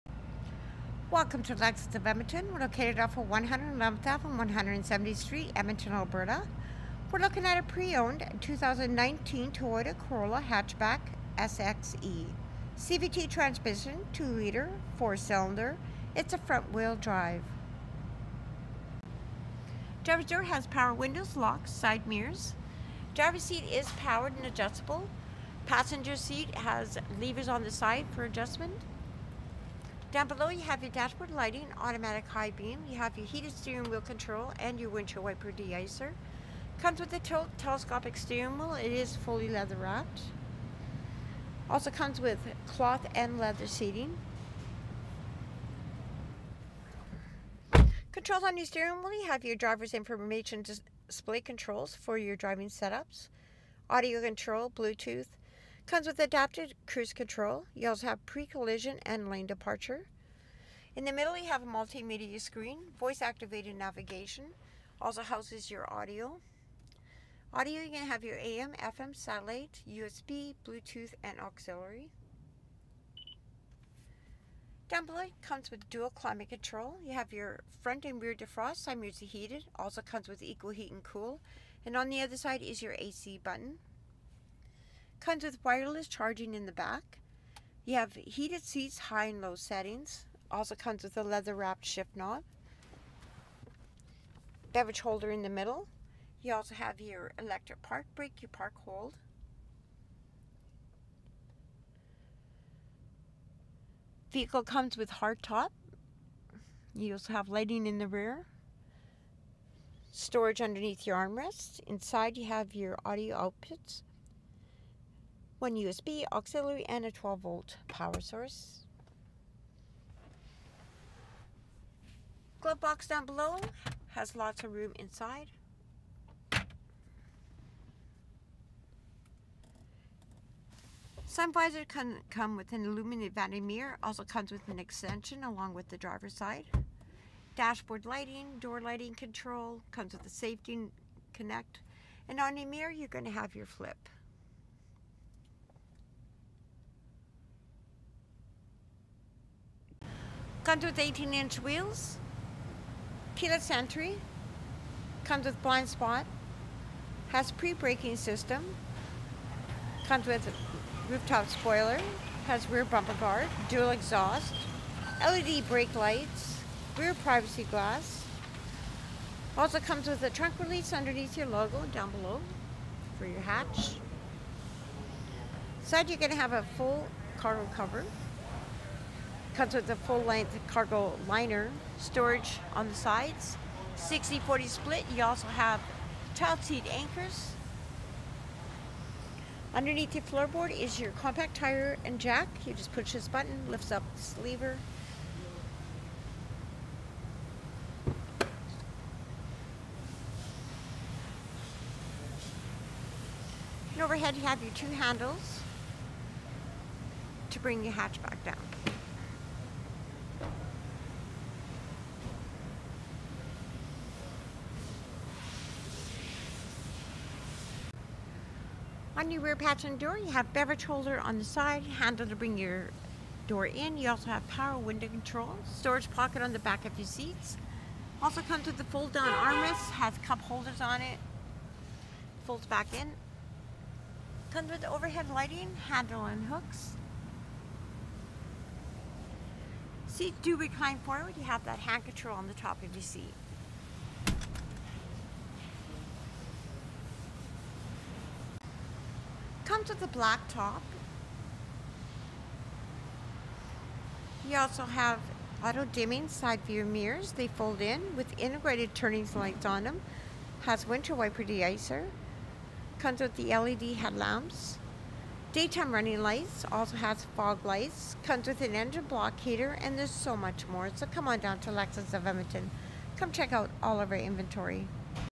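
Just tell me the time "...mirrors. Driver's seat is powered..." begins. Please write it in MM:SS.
00:22.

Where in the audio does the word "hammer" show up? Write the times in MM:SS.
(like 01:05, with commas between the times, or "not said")
not said.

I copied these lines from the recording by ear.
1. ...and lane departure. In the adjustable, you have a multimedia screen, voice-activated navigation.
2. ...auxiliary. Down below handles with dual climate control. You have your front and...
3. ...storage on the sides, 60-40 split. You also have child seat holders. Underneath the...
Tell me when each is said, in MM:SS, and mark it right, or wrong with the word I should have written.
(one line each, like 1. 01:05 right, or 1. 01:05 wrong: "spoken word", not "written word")
1. 00:59 wrong: "middle", not "adjustable"
2. 01:11 wrong: "comes", not "handles"
3. 03:01 wrong: "anchors", not "holders".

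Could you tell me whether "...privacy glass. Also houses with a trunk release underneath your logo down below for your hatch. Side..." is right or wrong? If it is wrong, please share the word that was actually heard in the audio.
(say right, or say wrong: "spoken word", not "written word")
wrong: "comes", not "houses".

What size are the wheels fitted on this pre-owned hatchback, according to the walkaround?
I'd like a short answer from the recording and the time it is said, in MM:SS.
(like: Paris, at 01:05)
18 inch, at 02:30.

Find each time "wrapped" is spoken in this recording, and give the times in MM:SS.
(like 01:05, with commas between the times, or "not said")
00:39, 01:31.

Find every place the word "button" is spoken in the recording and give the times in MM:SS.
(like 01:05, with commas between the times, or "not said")
01:23, 03:13.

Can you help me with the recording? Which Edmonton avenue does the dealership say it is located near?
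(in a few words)
111th Ave.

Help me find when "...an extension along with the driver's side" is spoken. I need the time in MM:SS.
02:14.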